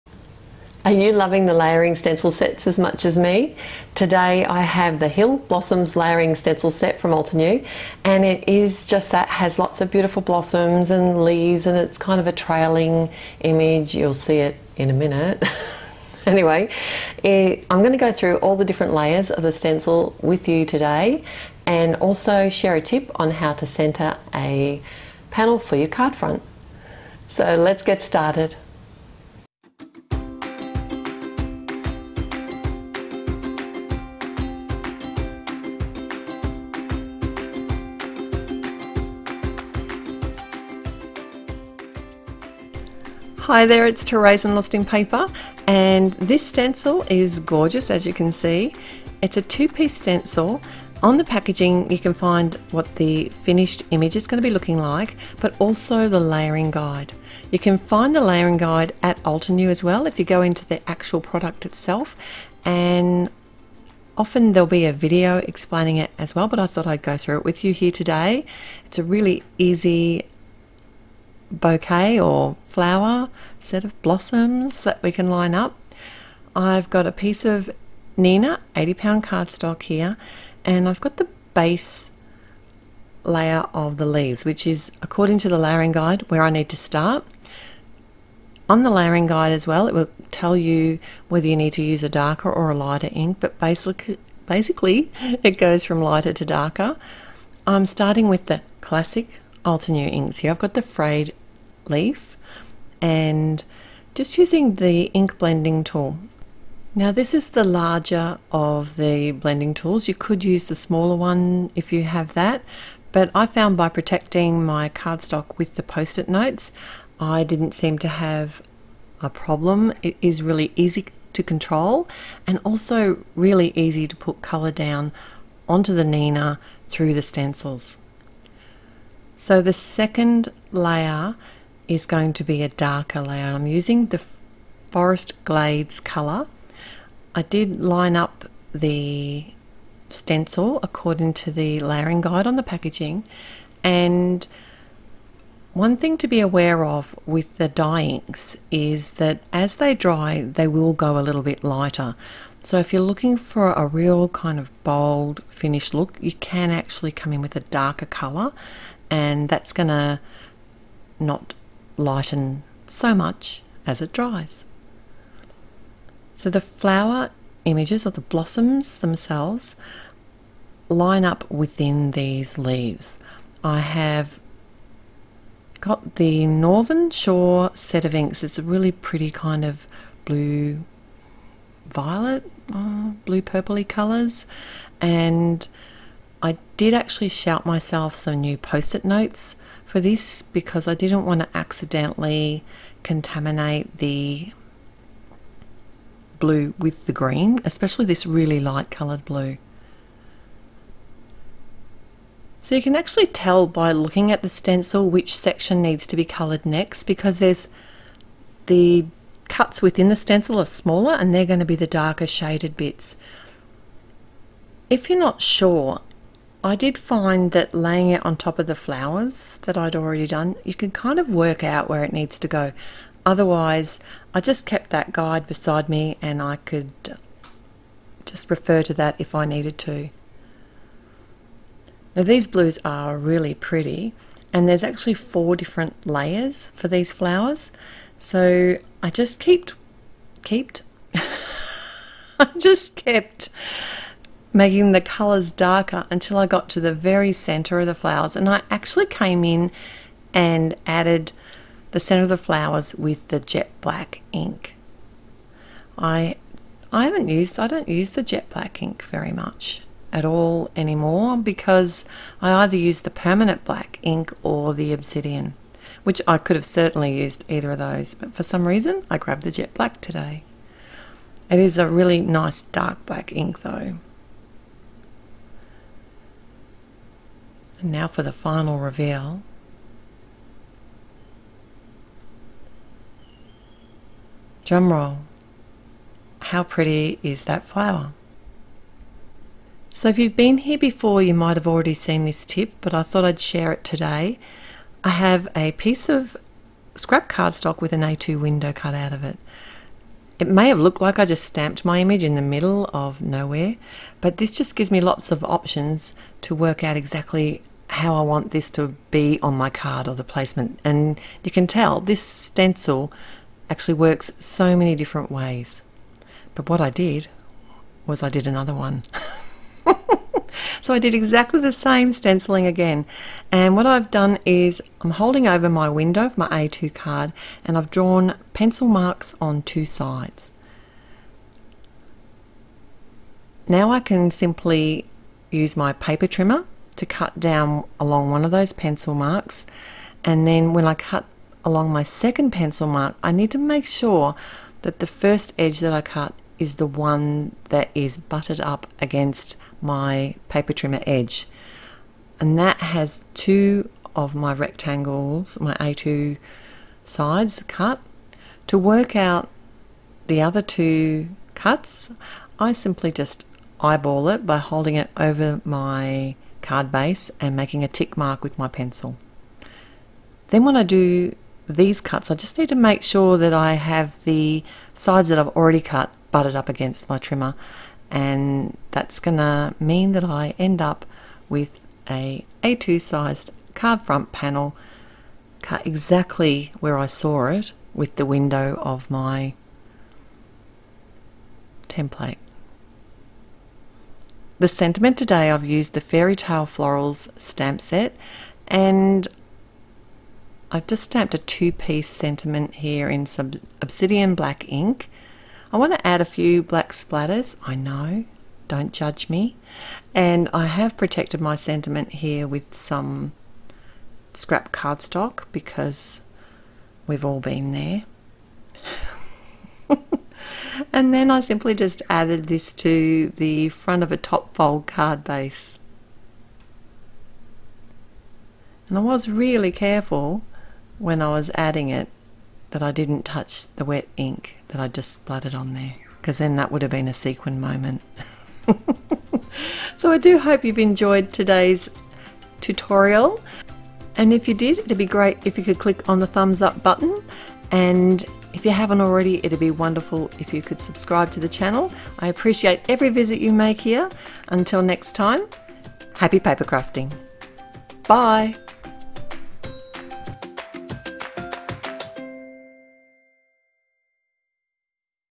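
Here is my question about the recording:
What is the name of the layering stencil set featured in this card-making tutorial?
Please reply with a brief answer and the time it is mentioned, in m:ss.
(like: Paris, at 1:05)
Hill Blossoms, at 0:05.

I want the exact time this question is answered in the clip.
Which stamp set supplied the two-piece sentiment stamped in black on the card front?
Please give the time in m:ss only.
6:36.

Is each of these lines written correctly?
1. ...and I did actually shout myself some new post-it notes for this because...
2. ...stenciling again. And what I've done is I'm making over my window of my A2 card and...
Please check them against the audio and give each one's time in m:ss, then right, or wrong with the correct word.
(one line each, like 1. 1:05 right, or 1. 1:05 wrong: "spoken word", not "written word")
1. 3:04 right
2. 5:22 wrong: "holding", not "making".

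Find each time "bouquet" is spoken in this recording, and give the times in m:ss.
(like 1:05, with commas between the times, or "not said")
1:11.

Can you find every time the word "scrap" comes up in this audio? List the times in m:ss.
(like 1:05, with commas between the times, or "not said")
4:56, 6:54.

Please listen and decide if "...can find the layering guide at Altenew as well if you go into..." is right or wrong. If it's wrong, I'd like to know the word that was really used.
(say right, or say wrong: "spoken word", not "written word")
right.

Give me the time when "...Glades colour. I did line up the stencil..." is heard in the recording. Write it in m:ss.
2:15.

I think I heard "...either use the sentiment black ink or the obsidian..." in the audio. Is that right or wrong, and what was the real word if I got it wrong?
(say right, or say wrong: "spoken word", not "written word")
wrong: "permanent", not "sentiment".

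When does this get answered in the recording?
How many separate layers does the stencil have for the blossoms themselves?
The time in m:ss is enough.
3:55.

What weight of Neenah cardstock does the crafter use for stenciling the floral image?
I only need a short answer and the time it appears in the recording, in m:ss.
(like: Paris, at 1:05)
80 pound, at 1:18.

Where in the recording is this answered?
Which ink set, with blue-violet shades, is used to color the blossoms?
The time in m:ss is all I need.
2:56.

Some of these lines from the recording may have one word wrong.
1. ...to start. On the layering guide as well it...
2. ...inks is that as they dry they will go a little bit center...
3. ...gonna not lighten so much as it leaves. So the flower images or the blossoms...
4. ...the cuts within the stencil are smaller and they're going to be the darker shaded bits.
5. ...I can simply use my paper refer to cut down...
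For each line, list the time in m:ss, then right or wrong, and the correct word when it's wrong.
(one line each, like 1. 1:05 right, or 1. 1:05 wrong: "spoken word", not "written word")
1. 1:26 right
2. 2:28 wrong: "lighter", not "center"
3. 2:39 wrong: "dries", not "leaves"
4. 3:28 right
5. 5:33 wrong: "trimmer", not "refer".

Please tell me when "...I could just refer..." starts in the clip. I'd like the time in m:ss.
3:46.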